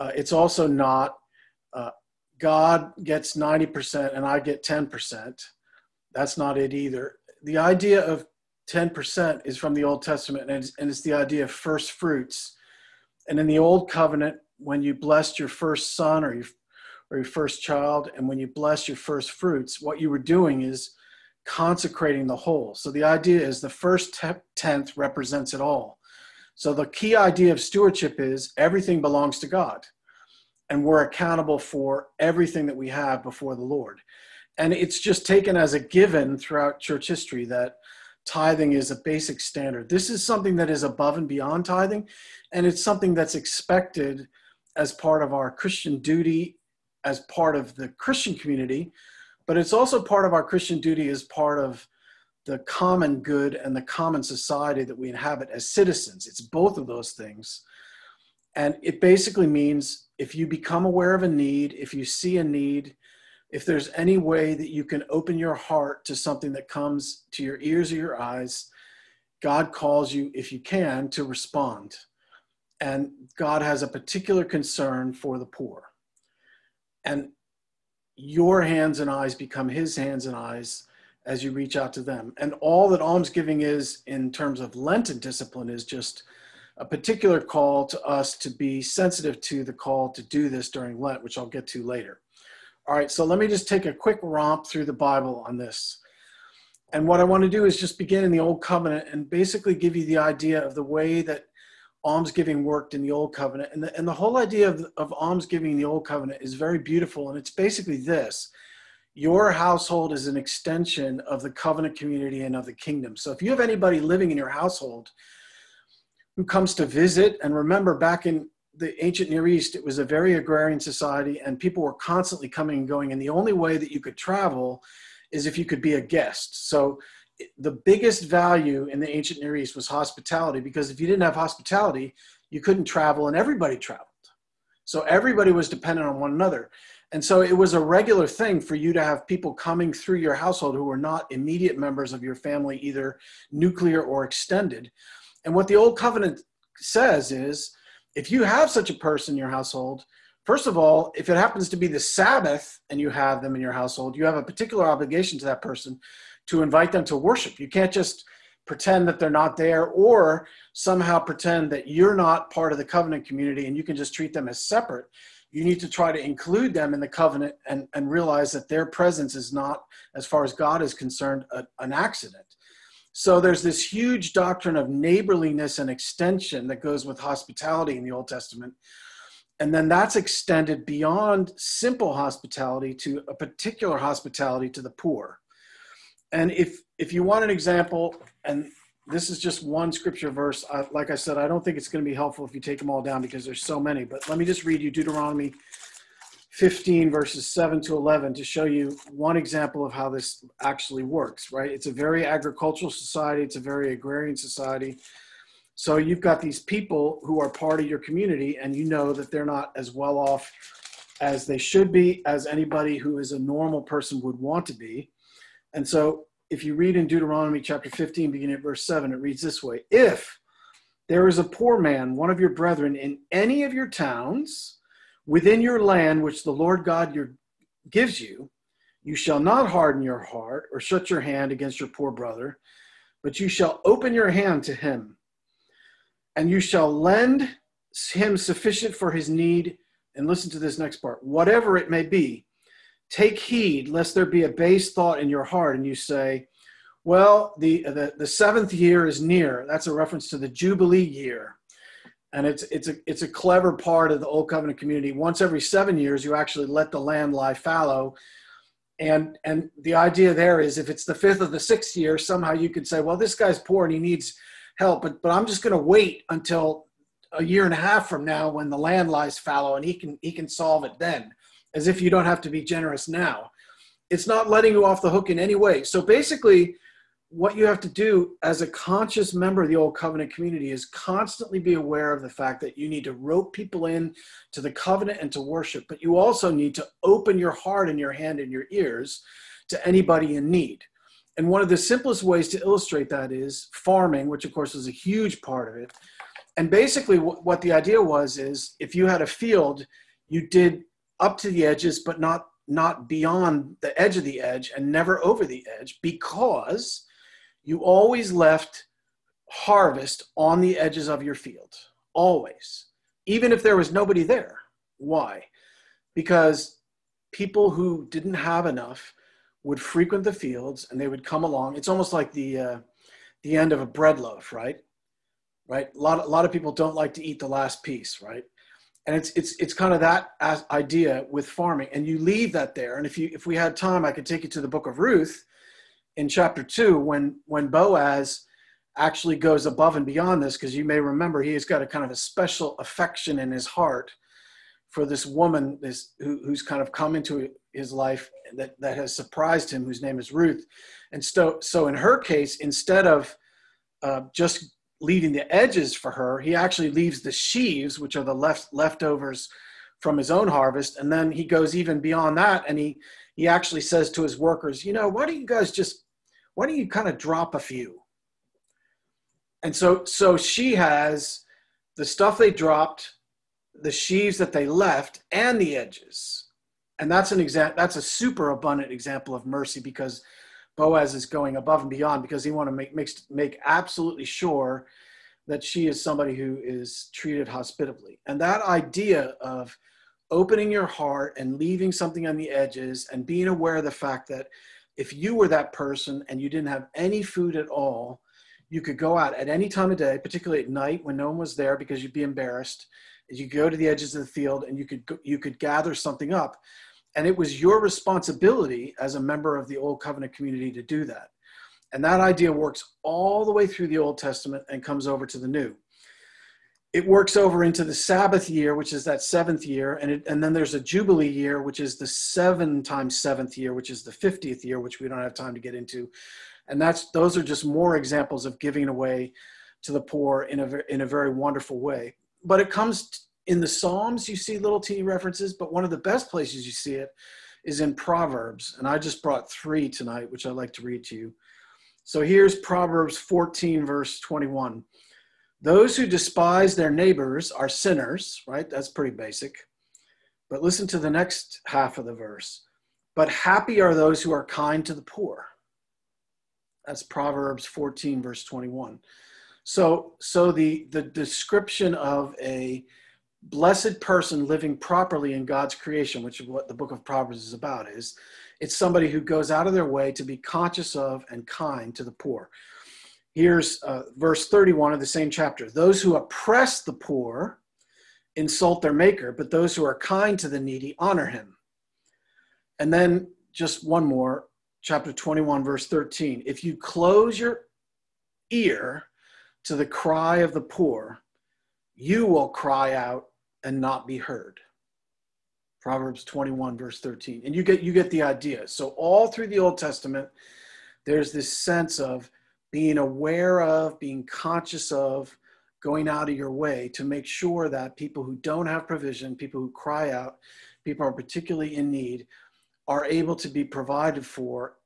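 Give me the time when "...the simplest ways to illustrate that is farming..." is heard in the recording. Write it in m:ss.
4:51.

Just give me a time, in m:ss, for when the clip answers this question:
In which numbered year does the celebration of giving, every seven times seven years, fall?
7:04.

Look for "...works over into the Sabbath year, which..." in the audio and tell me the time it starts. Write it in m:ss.
6:57.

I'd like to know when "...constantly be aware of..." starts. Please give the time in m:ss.
4:40.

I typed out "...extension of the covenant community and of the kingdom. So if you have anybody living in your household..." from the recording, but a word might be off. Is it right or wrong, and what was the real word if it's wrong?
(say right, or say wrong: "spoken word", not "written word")
right.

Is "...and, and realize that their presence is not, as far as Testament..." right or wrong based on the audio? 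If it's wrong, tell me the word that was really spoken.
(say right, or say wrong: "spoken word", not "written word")
wrong: "God", not "Testament".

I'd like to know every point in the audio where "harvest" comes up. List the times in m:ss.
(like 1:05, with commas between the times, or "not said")
5:09, 6:00.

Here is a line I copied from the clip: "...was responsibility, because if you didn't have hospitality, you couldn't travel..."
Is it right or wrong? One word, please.
wrong.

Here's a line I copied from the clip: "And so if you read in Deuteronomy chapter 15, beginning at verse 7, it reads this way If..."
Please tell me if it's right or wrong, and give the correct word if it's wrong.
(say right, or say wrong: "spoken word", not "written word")
right.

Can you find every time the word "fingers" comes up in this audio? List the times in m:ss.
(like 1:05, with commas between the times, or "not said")
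not said.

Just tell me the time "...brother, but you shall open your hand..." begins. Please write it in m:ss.
3:52.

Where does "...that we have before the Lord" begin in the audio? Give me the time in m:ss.
0:32.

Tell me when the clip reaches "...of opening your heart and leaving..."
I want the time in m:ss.
6:29.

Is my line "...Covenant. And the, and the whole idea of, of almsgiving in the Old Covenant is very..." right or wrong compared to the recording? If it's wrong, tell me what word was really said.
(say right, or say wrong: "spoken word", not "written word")
right.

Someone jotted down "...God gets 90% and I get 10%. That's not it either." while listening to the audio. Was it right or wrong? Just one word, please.
right.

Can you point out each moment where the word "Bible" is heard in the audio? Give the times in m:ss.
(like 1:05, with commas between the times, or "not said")
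1:34.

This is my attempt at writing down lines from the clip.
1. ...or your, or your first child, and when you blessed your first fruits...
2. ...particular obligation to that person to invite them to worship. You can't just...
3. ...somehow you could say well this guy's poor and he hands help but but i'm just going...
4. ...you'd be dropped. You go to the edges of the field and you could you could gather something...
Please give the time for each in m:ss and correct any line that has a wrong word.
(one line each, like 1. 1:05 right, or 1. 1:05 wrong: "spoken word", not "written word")
1. 0:16 right
2. 2:34 right
3. 4:22 wrong: "needs", not "hands"
4. 6:42 wrong: "embarrassed", not "dropped".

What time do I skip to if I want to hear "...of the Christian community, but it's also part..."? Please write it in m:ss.
0:47.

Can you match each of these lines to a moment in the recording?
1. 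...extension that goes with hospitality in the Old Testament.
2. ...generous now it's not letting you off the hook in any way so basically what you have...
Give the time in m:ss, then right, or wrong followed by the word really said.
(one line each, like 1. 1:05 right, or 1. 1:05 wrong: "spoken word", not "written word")
1. 2:55 right
2. 4:32 right.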